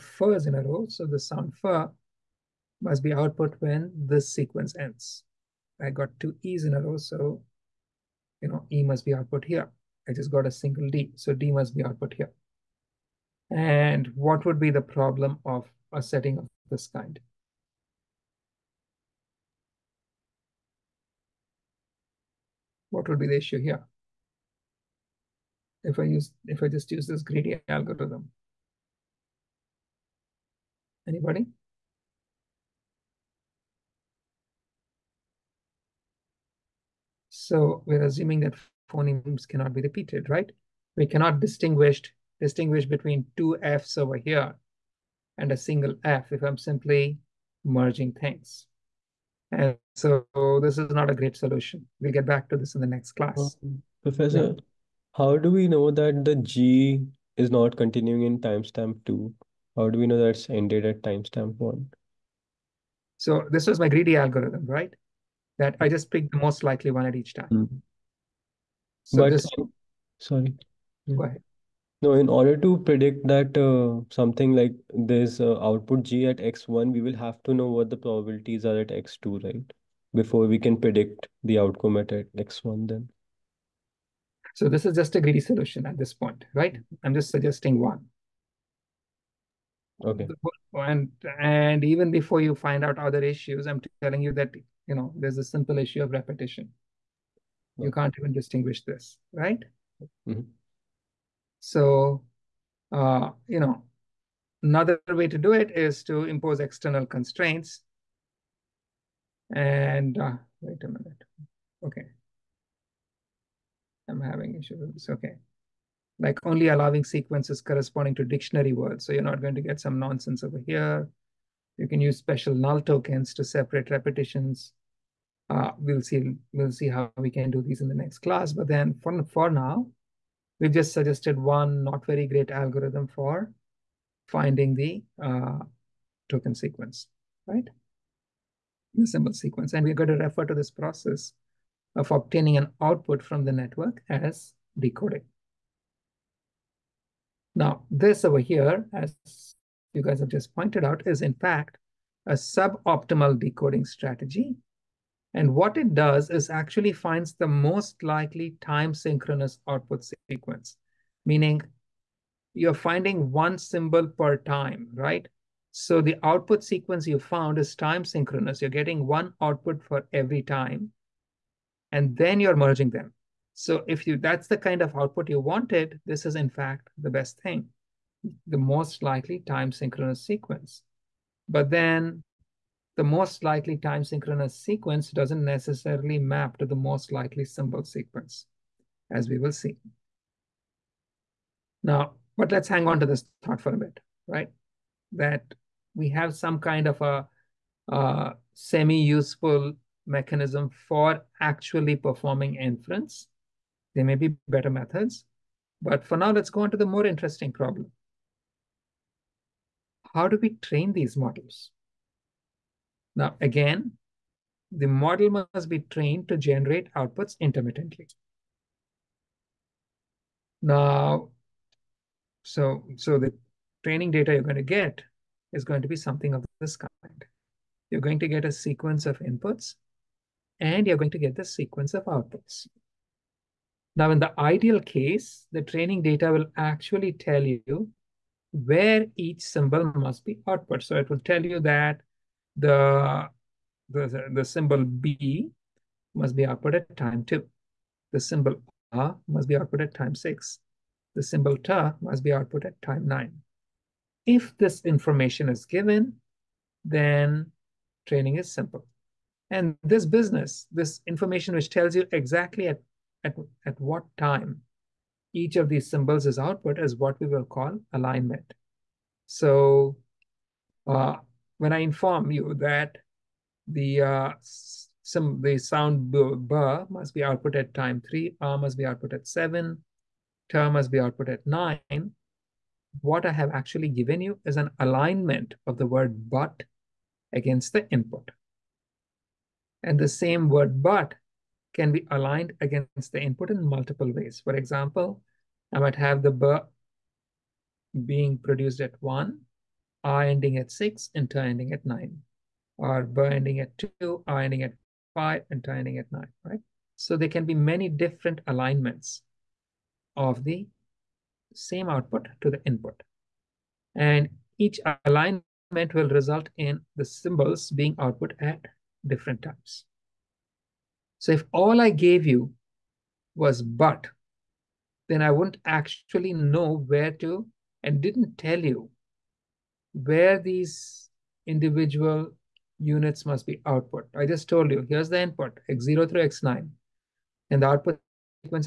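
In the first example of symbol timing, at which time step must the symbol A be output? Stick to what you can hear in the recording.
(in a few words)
6.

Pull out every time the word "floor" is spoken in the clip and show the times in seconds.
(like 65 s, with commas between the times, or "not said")
not said.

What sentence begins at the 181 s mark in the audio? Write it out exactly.
But then the most likely time synchronous sequence doesn't necessarily map to the most likely symbol sequence, as we will see.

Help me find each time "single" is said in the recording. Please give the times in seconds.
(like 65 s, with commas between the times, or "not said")
10 s, 45 s.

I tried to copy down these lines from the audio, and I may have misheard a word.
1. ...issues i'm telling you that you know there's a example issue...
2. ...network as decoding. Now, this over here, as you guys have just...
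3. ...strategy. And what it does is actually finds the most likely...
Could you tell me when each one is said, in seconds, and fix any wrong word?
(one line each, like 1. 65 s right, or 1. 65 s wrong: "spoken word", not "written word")
1. 93 s wrong: "simple", not "example"
2. 143 s right
3. 153 s right.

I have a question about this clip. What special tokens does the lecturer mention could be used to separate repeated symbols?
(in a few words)
null tokens.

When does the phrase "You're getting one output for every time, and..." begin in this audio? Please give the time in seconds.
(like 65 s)
168 s.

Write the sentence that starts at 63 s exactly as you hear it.
So this was my greedy algorithm, right?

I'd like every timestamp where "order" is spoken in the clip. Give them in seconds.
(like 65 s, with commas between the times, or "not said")
72 s.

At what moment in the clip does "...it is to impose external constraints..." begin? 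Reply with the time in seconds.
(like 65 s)
105 s.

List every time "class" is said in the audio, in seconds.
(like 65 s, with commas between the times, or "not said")
53 s, 128 s.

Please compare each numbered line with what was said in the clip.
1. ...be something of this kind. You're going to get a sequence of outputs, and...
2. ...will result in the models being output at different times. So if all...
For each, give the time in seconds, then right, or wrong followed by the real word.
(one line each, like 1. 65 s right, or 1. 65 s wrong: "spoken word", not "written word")
1. 225 s wrong: "inputs", not "outputs"
2. 315 s wrong: "symbols", not "models".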